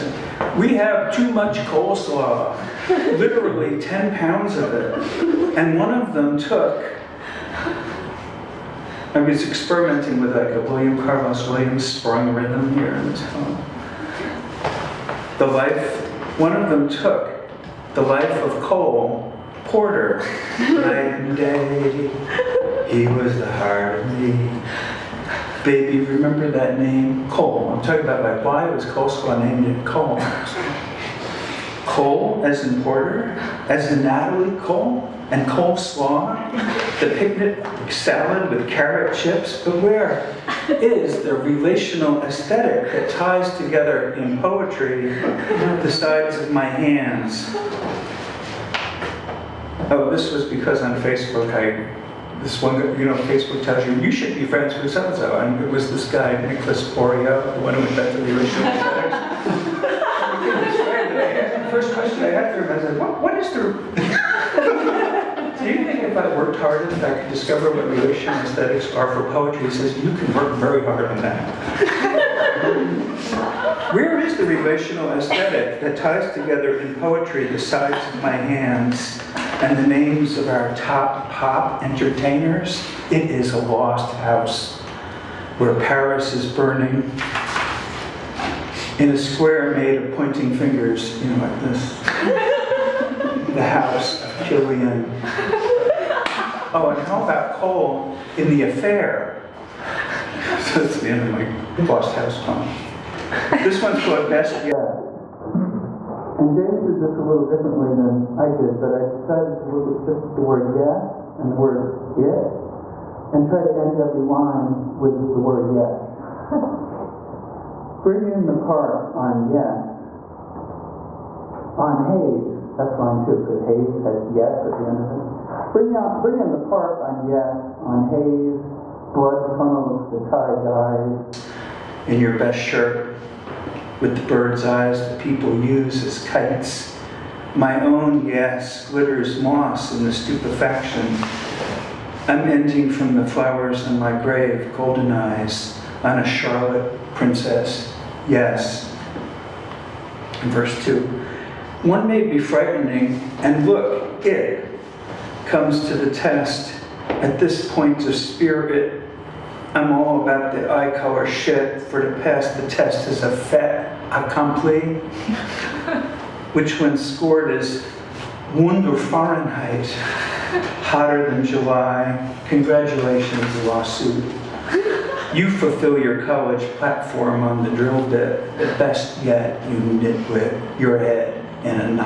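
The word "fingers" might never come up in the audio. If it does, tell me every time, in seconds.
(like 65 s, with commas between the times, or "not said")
90 s.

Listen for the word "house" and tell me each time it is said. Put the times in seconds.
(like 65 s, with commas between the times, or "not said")
84 s, 93 s, 102 s.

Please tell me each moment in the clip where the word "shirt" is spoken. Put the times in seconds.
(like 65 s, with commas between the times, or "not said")
132 s.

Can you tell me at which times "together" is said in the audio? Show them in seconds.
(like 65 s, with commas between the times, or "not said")
43 s, 76 s.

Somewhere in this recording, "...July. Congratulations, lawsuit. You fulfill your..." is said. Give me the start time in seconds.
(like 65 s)
171 s.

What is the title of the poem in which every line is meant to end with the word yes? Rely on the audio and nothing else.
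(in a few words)
Best Guess.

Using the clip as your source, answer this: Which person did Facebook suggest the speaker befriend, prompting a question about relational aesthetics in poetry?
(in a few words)
Nicolas Bourriaud.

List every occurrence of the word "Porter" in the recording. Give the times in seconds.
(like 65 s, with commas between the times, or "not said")
19 s, 32 s.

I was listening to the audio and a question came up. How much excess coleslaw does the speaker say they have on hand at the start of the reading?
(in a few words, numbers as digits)
10 pounds.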